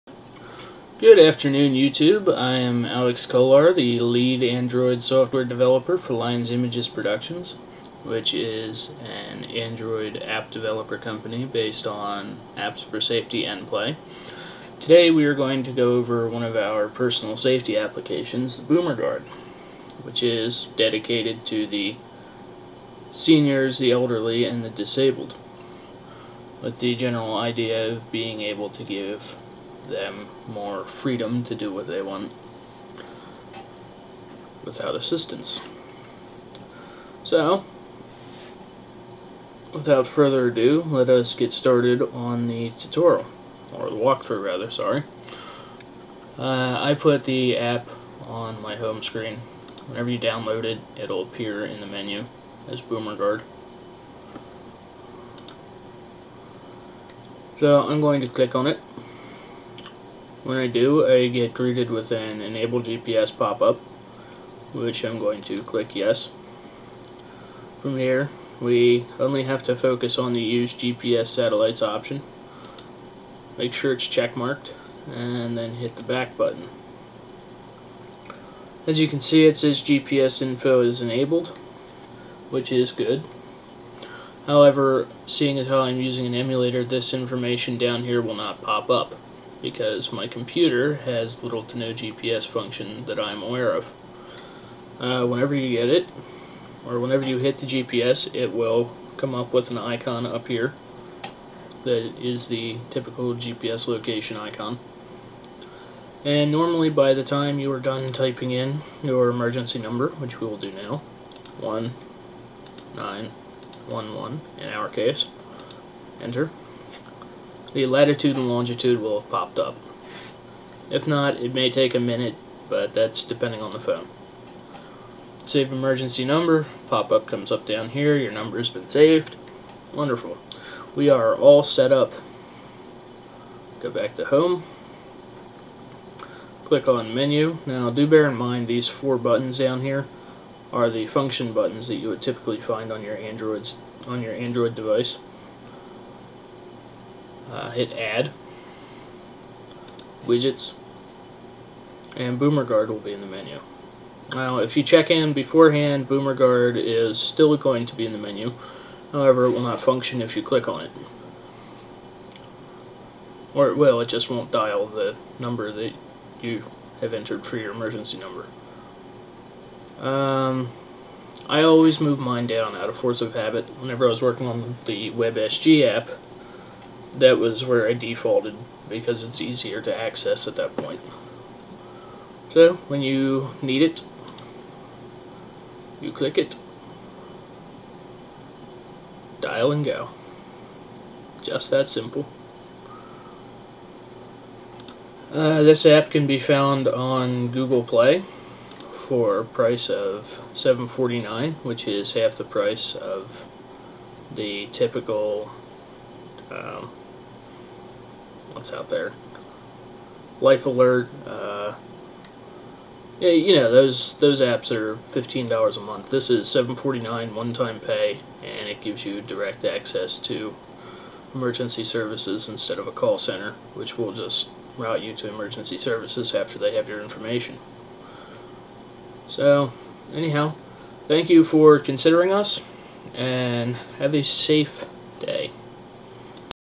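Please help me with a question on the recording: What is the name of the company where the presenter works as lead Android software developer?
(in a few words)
Lions Images Productions.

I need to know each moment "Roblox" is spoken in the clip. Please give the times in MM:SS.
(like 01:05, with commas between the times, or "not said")
not said.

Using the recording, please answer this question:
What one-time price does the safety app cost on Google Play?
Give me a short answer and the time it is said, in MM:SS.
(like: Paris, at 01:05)
$7.49, at 03:20.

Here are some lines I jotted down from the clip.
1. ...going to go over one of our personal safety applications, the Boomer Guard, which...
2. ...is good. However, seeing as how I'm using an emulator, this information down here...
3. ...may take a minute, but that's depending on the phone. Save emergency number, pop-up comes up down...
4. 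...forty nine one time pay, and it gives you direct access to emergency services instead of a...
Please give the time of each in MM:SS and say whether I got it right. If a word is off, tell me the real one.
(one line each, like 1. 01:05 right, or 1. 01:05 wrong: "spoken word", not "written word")
1. 00:15 right
2. 01:22 right
3. 02:01 right
4. 03:36 right.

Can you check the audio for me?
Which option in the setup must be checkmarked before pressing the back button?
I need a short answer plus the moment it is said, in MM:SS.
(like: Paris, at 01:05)
Use GPS Satellites, at 01:10.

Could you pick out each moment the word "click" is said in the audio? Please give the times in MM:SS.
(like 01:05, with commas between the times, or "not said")
00:58, 01:05, 02:16, 02:40, 03:06.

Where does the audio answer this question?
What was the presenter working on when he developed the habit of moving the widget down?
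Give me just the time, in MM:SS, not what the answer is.
02:55.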